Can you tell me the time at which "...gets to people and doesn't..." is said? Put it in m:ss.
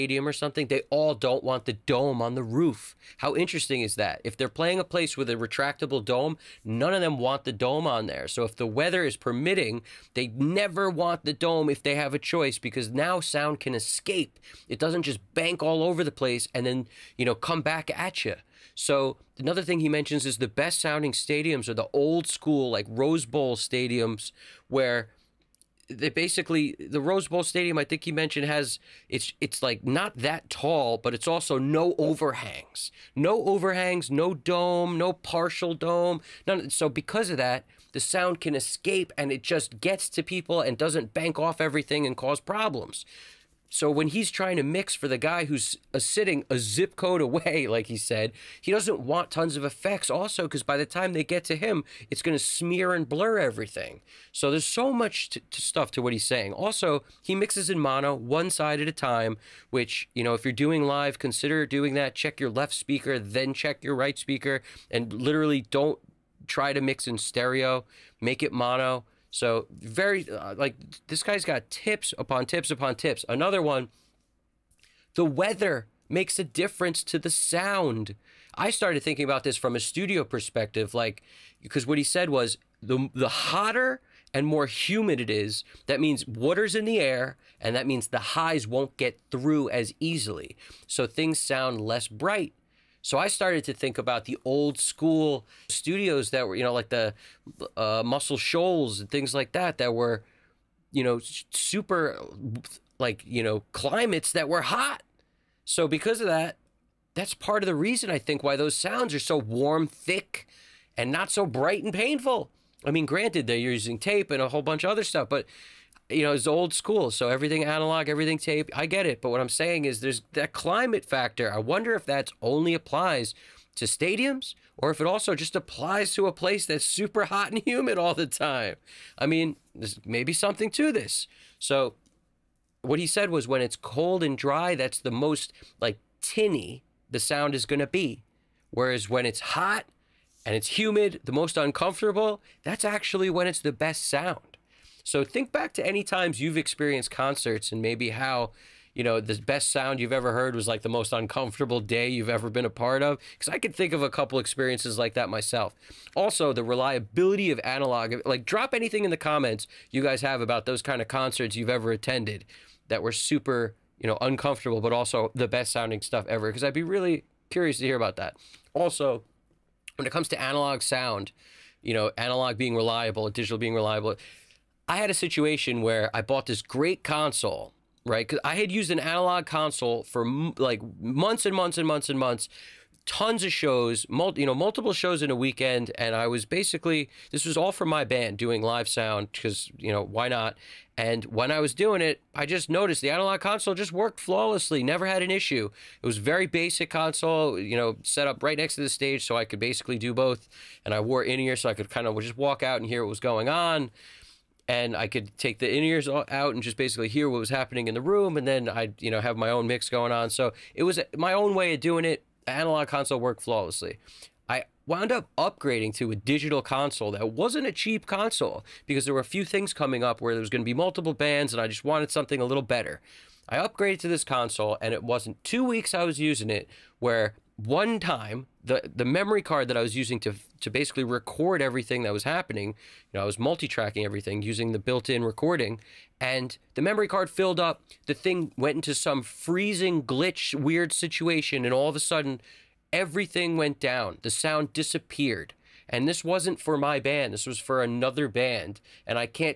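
0:39.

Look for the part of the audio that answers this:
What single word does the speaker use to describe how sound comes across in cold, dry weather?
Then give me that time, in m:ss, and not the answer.
2:16.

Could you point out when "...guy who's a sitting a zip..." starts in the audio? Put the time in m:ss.
0:45.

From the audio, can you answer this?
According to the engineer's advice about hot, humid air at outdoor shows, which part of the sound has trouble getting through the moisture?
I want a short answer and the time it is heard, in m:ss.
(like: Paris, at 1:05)
the highs, at 1:28.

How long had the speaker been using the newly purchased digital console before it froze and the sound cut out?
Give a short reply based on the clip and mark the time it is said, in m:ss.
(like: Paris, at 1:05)
2 weeks, at 3:45.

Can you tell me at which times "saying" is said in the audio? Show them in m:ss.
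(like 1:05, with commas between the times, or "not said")
0:56, 1:59.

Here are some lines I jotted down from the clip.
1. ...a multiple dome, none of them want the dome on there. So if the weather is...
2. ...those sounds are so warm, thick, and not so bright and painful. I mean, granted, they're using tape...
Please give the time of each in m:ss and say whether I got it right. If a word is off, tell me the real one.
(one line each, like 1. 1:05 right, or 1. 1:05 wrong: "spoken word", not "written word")
1. 0:05 wrong: "retractable", not "multiple"
2. 1:48 right.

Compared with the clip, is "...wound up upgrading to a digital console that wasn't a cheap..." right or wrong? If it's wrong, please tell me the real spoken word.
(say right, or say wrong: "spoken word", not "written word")
right.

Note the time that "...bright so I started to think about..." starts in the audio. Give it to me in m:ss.
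1:32.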